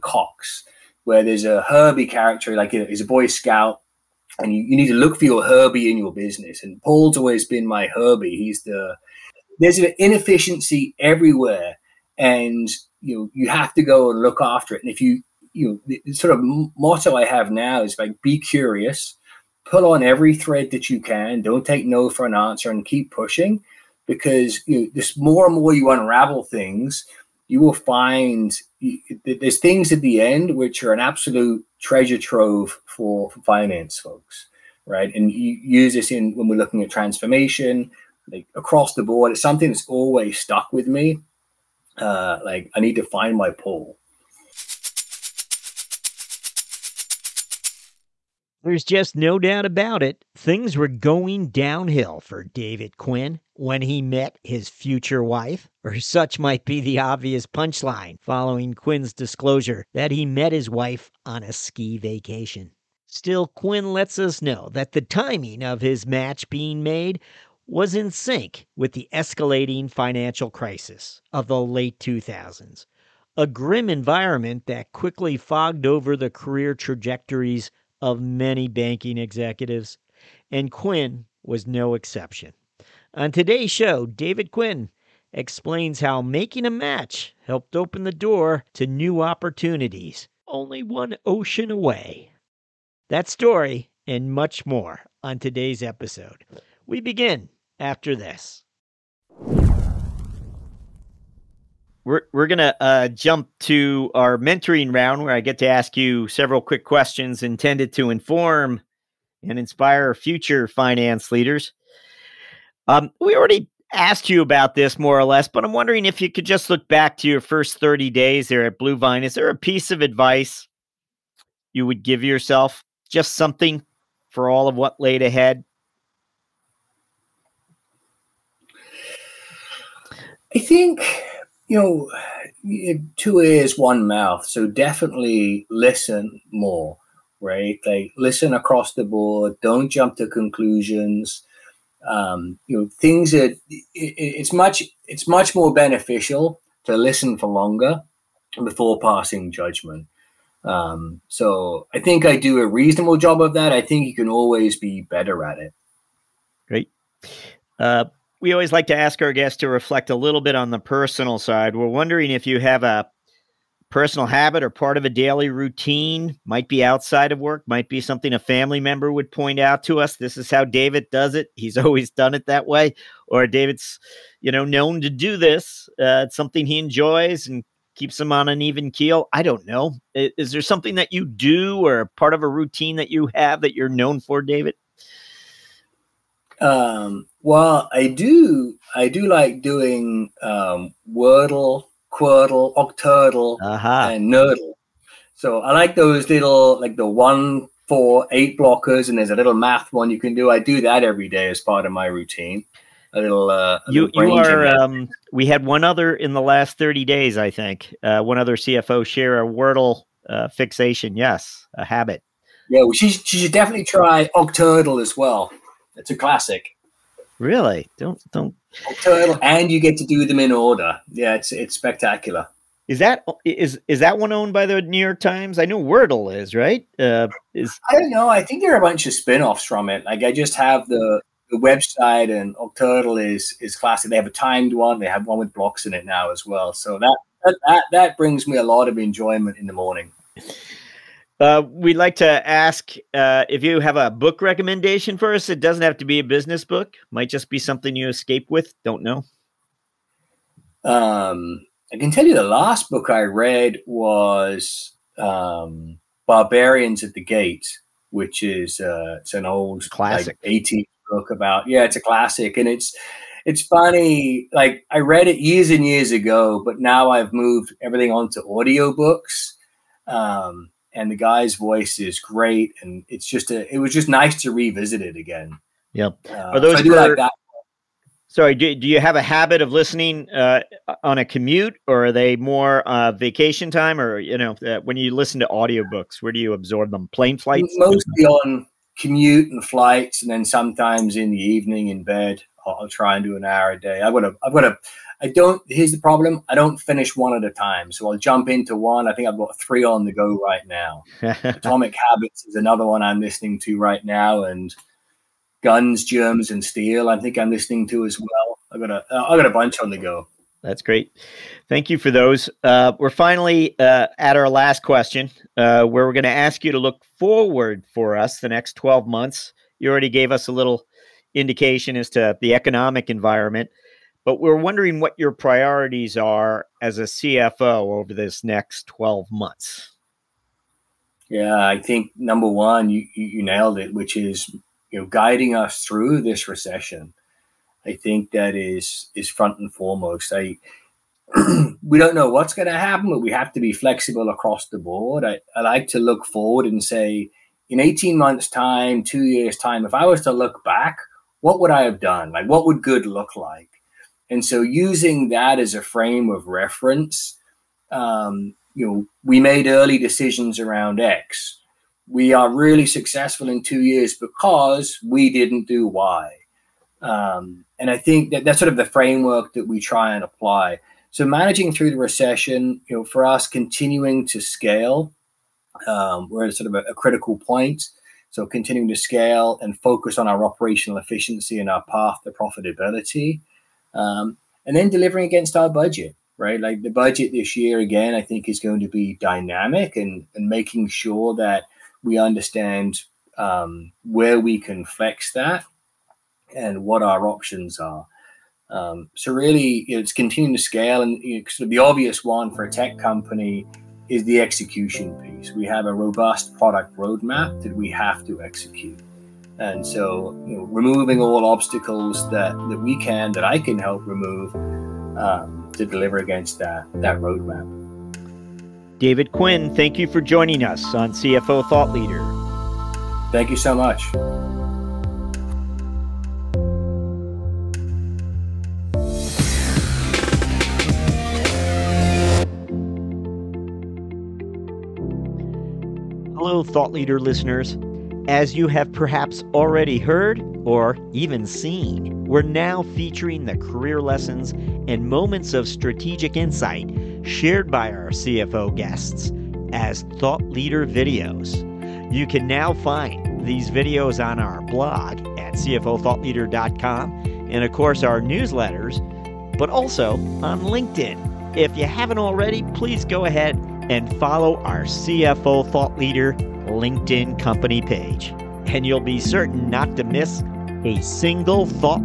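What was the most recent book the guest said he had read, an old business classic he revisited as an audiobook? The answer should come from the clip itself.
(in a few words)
Barbarians at the Gate.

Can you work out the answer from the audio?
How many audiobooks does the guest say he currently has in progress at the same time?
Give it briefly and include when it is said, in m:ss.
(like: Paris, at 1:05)
3, at 4:59.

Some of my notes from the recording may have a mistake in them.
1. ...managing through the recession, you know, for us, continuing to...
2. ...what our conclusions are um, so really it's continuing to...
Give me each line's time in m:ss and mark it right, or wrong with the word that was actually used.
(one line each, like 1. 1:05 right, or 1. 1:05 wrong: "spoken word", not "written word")
1. 6:11 right
2. 6:36 wrong: "options", not "conclusions".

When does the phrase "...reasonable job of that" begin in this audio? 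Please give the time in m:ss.
2:32.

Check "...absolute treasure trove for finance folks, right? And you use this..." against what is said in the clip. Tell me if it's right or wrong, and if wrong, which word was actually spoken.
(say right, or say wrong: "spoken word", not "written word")
right.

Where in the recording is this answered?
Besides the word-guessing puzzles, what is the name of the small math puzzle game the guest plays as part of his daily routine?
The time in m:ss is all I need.
3:14.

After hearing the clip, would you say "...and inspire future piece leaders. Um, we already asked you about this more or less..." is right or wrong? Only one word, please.
wrong.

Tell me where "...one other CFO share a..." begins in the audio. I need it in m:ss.
3:28.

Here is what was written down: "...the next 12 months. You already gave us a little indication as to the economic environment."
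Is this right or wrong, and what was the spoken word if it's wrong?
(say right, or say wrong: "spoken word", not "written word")
right.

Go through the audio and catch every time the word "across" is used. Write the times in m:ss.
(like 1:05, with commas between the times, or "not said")
0:38, 2:18, 5:44.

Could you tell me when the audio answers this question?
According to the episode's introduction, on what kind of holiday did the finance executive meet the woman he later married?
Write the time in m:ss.
1:01.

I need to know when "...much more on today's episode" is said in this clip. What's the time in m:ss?
1:34.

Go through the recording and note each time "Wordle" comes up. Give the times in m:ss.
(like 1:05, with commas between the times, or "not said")
3:11, 3:29, 3:45.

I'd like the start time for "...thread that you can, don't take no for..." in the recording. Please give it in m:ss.
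0:20.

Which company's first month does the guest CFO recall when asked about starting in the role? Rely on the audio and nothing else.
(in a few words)
Bluevine.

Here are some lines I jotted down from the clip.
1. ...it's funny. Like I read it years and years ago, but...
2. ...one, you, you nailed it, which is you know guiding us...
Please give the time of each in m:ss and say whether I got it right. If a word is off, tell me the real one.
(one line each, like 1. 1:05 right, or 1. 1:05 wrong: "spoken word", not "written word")
1. 4:23 right
2. 5:32 right.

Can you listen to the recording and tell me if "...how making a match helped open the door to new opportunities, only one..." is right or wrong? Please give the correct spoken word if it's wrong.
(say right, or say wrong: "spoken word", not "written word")
right.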